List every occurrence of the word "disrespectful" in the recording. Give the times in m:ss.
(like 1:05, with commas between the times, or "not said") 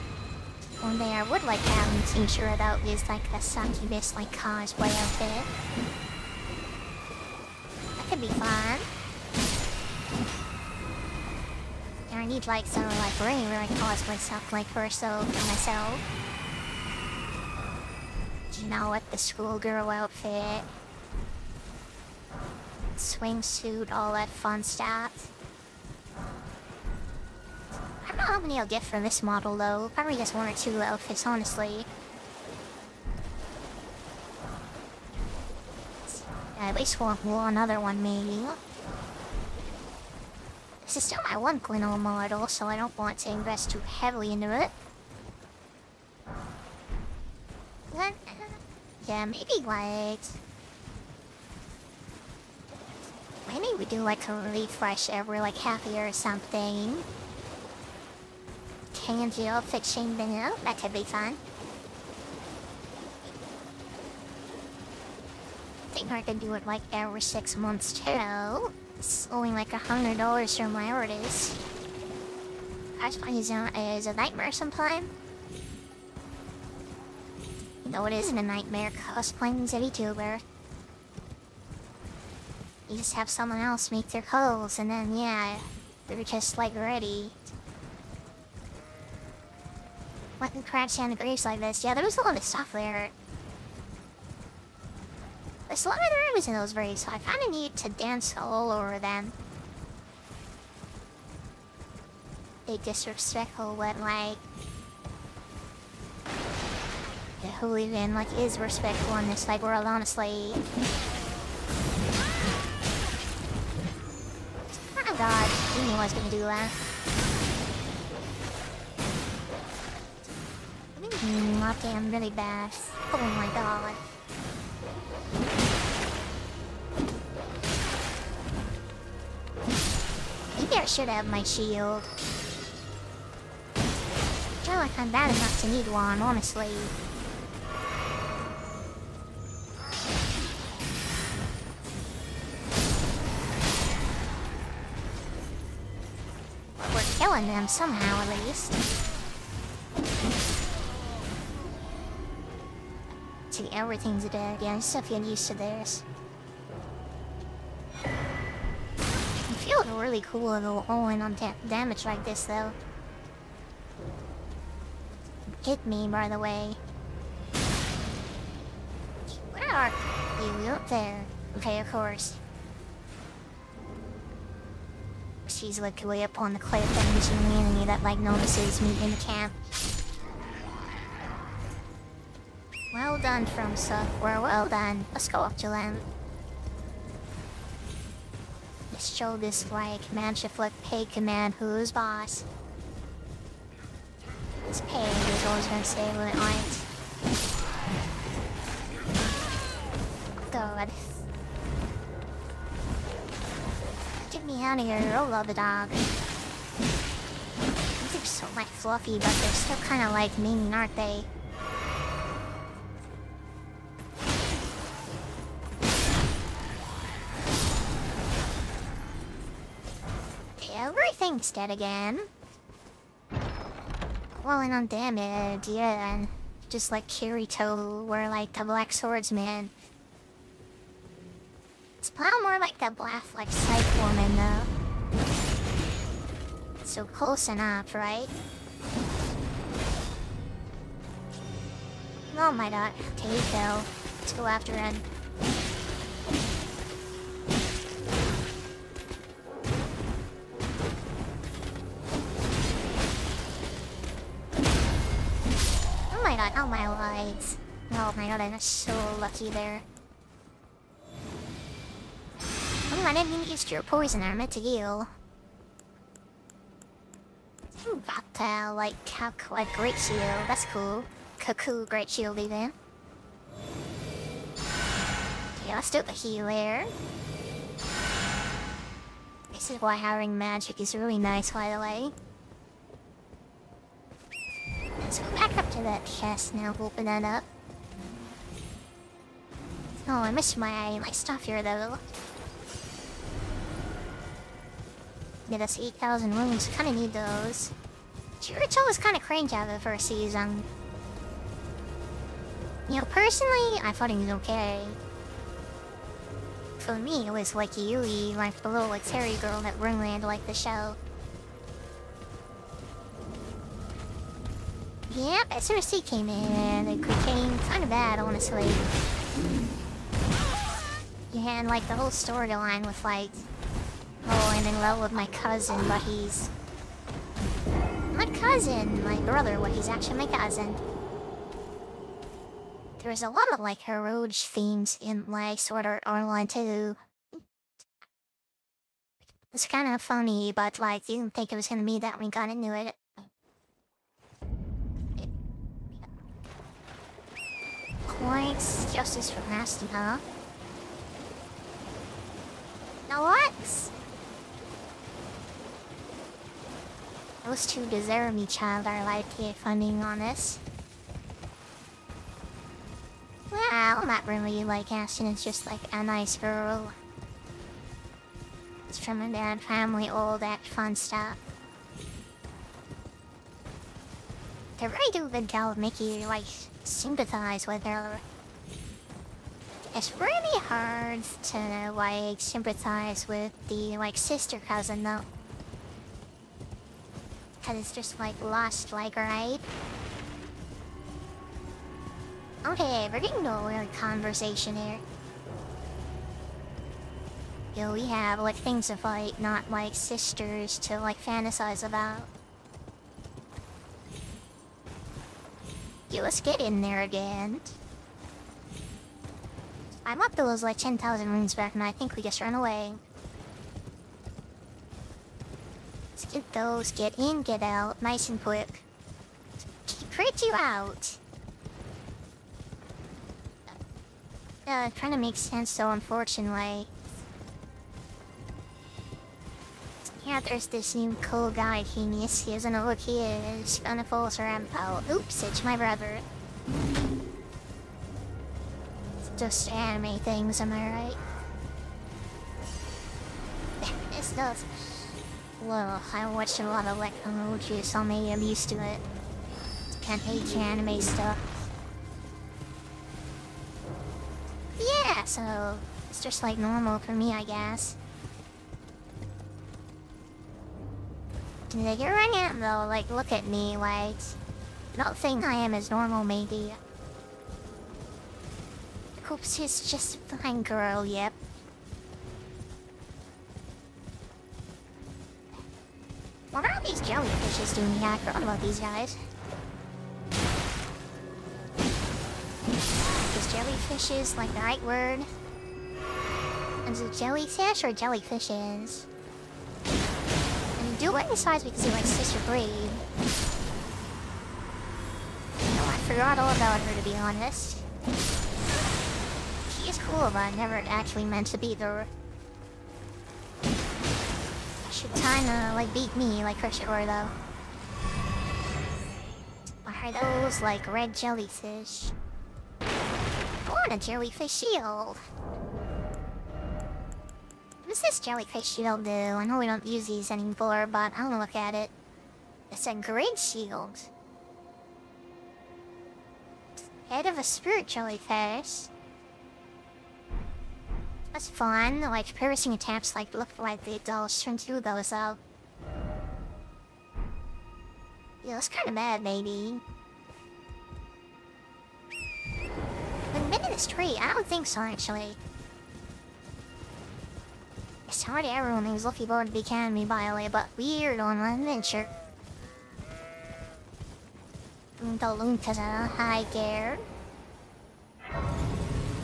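1:42.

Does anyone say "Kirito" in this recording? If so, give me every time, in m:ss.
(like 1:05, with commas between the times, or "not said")
3:47, 4:58.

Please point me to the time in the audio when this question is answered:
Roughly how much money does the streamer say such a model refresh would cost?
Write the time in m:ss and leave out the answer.
1:09.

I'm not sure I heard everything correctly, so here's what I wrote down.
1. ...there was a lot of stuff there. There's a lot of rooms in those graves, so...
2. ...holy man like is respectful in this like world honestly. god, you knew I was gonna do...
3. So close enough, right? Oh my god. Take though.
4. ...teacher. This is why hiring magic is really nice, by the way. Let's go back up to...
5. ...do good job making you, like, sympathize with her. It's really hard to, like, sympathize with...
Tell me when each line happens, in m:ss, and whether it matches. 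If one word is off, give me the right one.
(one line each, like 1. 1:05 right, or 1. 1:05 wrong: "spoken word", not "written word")
1. 1:31 right
2. 1:47 right
3. 3:56 right
4. 4:36 wrong: "healer", not "teacher"
5. 6:15 right.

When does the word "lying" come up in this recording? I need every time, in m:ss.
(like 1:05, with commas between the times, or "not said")
not said.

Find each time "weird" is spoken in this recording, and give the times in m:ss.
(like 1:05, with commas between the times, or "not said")
6:33, 9:10.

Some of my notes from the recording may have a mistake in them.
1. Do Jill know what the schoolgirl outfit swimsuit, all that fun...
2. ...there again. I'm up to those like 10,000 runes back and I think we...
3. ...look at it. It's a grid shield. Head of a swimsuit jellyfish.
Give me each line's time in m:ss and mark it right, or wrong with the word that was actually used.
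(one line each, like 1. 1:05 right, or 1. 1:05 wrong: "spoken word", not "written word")
1. 0:18 wrong: "You", not "Jill"
2. 6:46 right
3. 8:41 wrong: "spirit", not "swimsuit".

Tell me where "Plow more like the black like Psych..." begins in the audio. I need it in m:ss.
3:52.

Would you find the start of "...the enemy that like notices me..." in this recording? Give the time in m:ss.
2:57.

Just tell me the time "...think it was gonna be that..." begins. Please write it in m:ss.
5:41.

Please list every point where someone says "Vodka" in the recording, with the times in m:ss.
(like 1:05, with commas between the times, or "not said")
4:27.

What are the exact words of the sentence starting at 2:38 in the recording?
It feels really cool to go all in on da damage like this, though.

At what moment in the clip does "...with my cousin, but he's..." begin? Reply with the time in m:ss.
5:24.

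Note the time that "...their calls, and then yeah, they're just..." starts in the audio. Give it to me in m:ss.
1:24.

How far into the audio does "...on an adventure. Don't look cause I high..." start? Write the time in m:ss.
9:11.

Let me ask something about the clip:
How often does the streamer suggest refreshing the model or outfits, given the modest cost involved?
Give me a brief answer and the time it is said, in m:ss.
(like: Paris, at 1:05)
every six months, at 1:06.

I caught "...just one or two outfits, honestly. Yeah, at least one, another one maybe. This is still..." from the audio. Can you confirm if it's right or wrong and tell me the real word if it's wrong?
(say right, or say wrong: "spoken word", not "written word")
right.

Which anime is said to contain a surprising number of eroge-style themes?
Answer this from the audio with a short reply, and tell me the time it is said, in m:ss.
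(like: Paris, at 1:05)
Sword Art Online, at 5:35.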